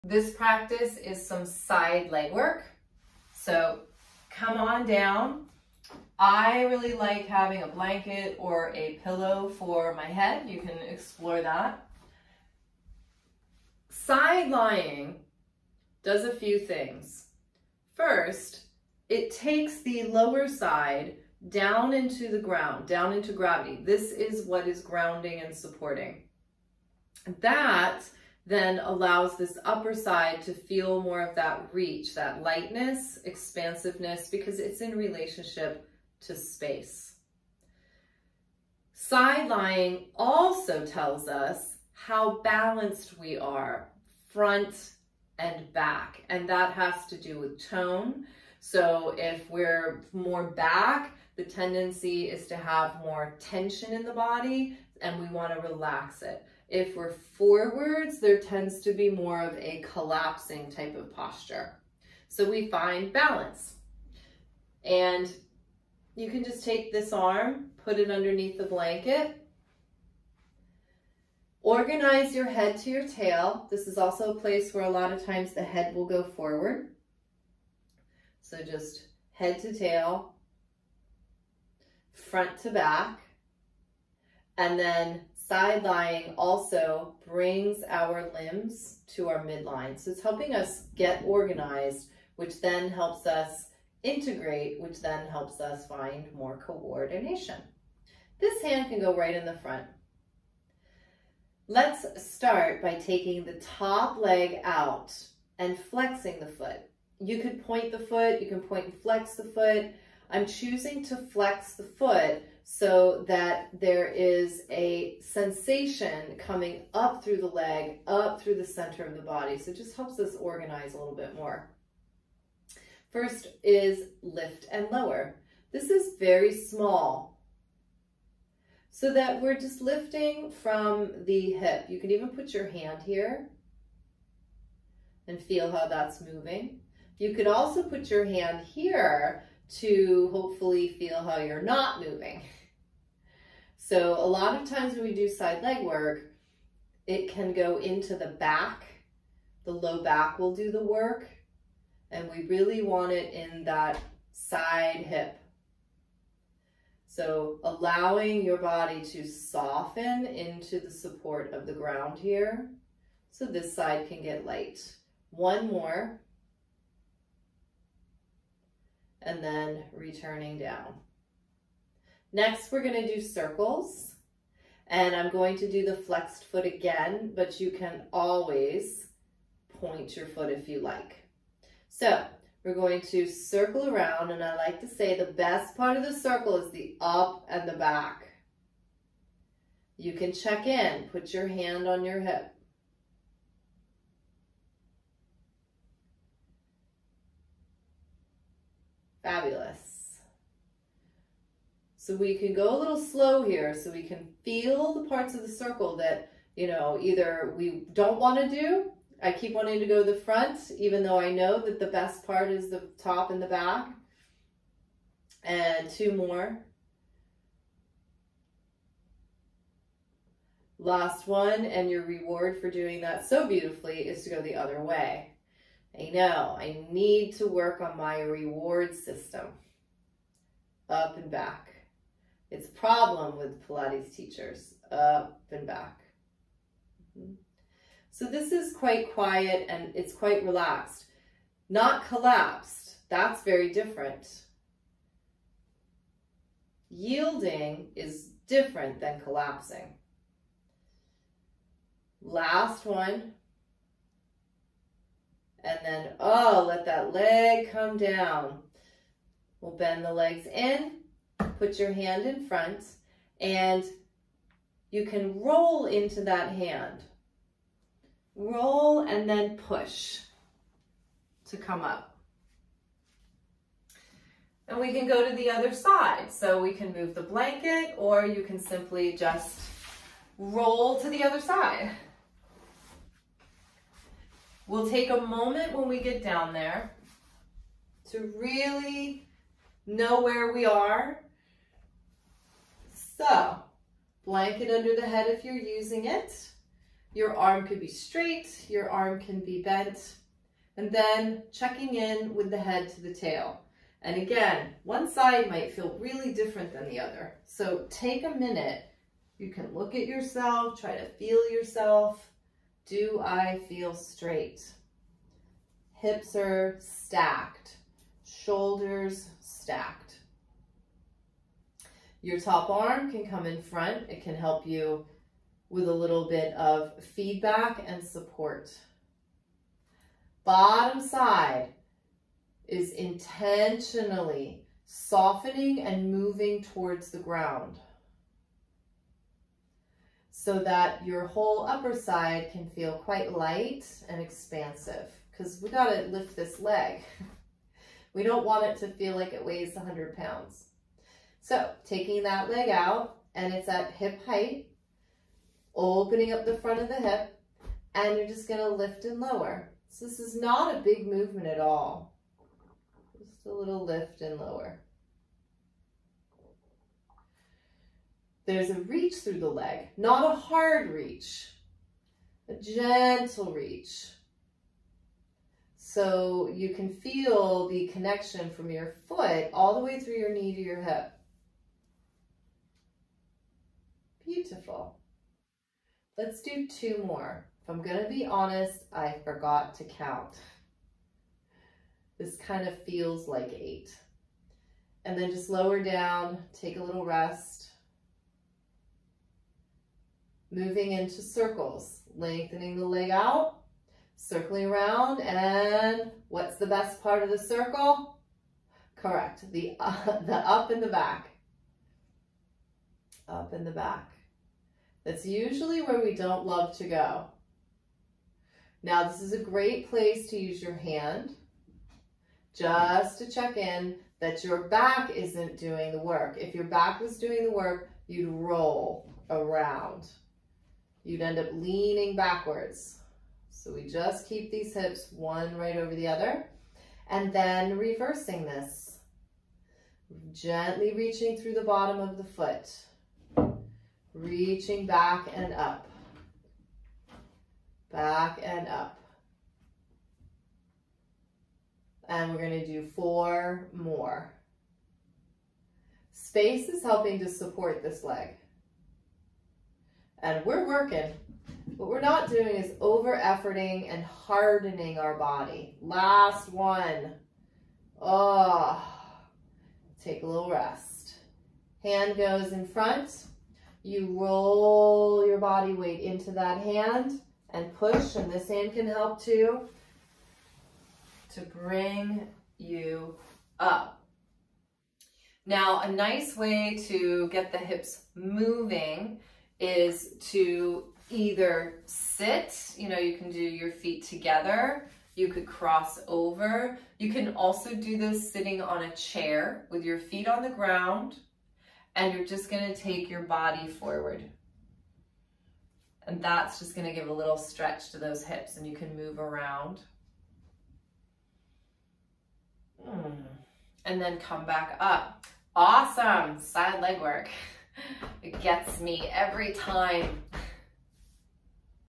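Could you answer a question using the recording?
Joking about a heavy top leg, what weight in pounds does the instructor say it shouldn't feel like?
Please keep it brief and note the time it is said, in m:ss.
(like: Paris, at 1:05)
100, at 5:49.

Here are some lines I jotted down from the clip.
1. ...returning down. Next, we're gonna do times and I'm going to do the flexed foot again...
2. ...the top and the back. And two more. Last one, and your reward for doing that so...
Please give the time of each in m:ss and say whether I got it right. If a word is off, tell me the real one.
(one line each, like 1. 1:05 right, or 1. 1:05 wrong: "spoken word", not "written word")
1. 2:49 wrong: "circles", not "times"
2. 3:32 right.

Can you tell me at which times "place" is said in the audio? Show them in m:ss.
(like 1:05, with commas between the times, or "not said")
1:14, 6:59.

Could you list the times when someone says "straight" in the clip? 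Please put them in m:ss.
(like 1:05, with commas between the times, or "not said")
4:57, 5:13.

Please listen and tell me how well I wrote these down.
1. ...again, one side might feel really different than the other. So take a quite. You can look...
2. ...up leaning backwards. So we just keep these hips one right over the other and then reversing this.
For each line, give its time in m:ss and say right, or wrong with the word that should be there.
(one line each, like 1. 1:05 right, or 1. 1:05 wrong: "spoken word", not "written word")
1. 5:04 wrong: "minute", not "quite"
2. 7:11 right.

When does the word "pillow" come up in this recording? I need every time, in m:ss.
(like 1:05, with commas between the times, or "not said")
0:09.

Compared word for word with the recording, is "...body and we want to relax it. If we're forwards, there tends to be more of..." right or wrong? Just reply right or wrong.
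right.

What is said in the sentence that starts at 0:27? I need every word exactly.
That then allows this upper side to feel more of that reach, that lightness, expansiveness, because it's in relationship to space.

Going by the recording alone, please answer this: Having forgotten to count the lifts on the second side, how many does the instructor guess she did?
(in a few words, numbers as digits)
8.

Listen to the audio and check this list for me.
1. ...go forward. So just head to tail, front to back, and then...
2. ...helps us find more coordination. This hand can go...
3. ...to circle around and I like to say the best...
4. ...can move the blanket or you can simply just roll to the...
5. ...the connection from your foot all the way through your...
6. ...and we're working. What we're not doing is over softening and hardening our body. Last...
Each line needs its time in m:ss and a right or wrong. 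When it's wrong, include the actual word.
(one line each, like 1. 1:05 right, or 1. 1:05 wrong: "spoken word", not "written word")
1. 1:16 right
2. 1:35 right
3. 3:03 right
4. 4:36 right
5. 6:17 right
6. 7:40 wrong: "efforting", not "softening".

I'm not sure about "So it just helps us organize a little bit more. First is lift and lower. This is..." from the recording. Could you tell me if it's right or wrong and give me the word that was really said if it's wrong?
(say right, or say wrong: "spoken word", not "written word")
right.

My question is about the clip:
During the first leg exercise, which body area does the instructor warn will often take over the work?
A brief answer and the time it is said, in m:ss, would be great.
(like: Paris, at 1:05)
low back, at 2:29.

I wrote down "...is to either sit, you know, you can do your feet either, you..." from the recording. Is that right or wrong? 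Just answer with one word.
wrong.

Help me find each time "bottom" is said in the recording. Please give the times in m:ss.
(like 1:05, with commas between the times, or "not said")
5:30, 7:21.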